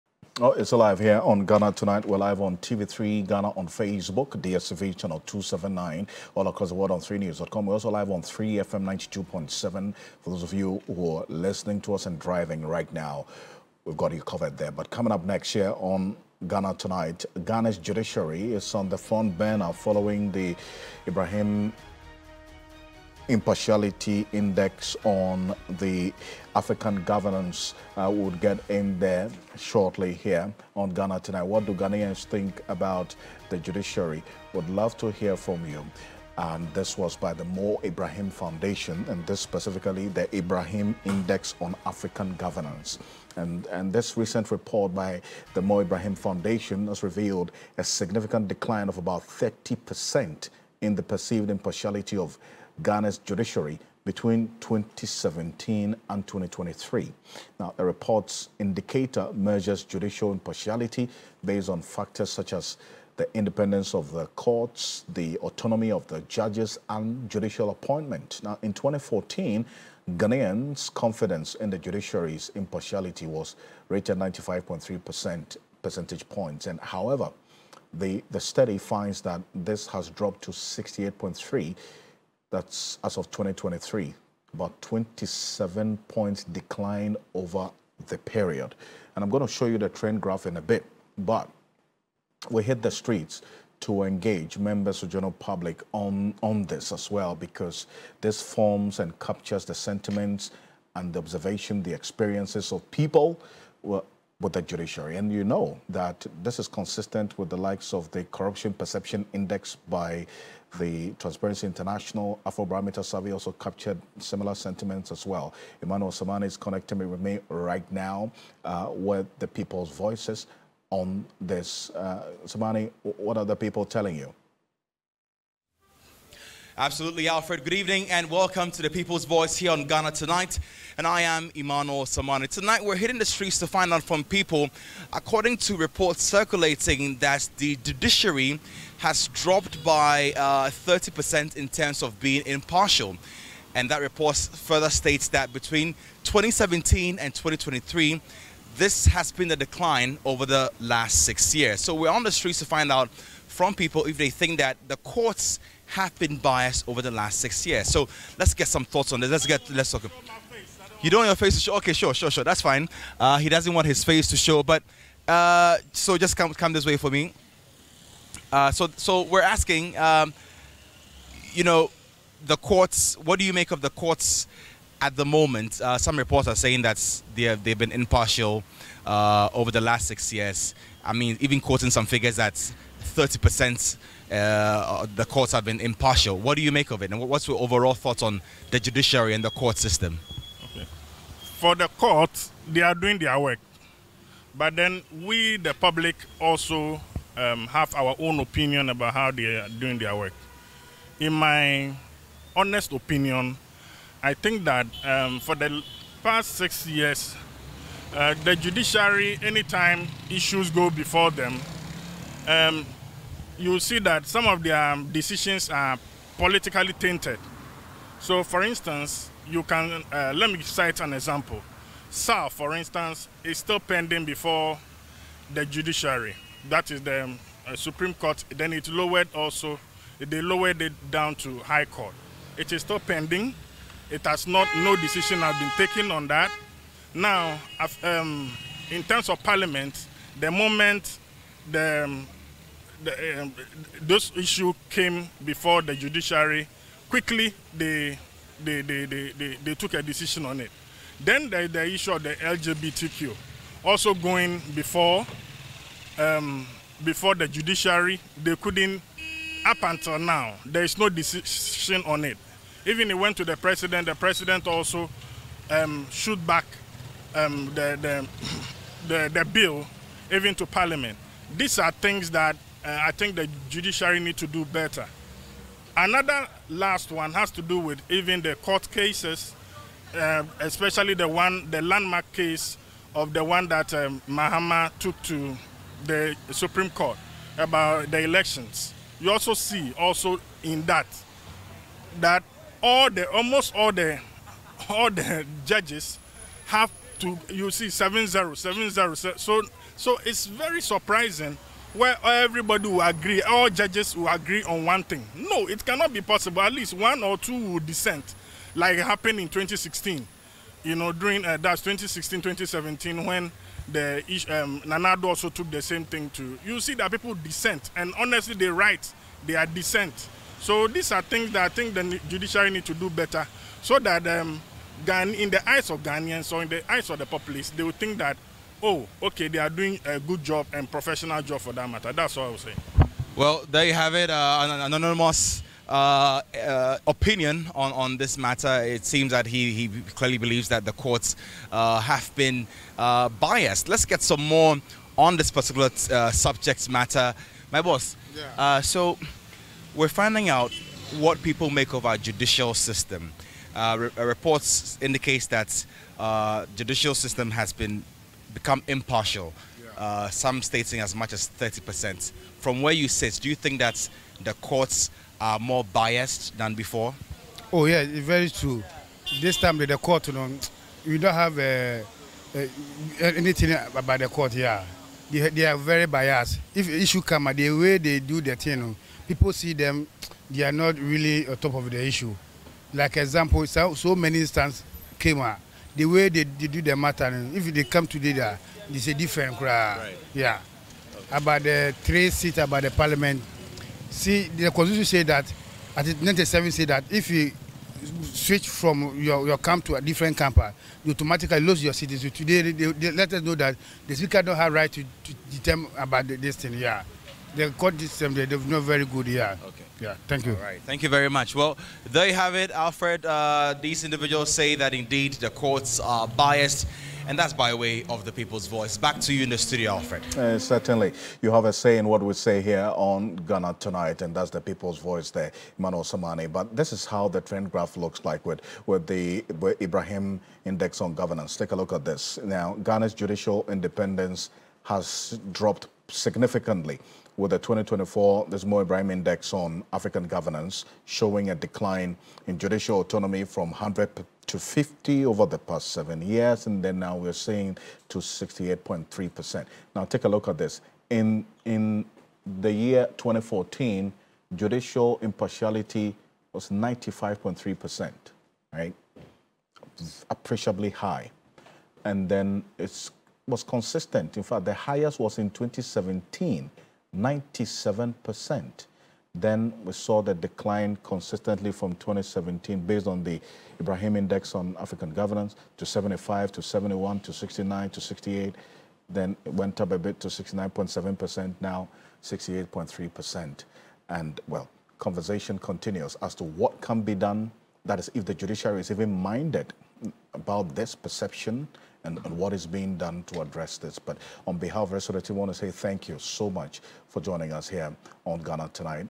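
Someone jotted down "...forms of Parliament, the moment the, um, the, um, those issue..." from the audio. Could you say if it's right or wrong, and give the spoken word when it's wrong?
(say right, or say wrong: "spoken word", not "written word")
wrong: "terms", not "forms".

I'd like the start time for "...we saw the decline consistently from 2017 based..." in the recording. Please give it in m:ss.
7:49.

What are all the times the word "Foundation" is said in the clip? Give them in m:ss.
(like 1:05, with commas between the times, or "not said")
0:38, 0:46.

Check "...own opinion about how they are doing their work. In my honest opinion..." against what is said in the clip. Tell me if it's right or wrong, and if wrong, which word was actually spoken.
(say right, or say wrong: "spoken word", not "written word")
right.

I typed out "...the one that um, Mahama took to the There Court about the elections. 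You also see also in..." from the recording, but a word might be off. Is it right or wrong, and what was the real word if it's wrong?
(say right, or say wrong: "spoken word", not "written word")
wrong: "Supreme", not "There".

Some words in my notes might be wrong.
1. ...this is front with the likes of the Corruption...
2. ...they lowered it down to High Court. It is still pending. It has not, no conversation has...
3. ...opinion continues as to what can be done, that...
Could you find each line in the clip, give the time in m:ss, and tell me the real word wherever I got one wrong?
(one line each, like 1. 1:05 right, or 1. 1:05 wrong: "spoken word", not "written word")
1. 1:46 wrong: "consistent", not "front"
2. 3:50 wrong: "decision", not "conversation"
3. 8:04 wrong: "conversation", not "opinion".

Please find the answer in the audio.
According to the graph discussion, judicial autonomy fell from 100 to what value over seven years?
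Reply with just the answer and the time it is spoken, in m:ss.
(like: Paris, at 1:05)
50, at 7:24.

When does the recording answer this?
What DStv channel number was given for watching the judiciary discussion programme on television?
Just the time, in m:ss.
0:04.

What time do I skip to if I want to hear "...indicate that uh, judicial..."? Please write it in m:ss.
5:55.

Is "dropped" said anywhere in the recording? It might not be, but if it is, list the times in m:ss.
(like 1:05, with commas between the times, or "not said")
1:20, 2:19, 7:15.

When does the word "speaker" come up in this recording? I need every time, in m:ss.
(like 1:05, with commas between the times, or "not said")
6:44.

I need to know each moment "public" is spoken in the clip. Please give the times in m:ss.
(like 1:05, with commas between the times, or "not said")
1:35, 3:15.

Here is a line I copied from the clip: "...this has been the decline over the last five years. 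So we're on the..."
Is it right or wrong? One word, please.
wrong.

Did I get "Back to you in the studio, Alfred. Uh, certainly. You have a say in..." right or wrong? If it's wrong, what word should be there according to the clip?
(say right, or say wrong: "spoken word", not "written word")
right.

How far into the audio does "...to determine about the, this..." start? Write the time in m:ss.
6:45.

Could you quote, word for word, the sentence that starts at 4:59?
So so it's very surprising where everybody will agree, all judges will agree on one thing.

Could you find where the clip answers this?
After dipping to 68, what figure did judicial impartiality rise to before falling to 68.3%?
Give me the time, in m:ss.
8:00.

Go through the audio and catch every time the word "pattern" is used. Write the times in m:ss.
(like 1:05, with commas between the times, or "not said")
not said.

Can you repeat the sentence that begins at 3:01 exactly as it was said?
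I mean, even quoting some figures that 30% uh, the courts have been impartial.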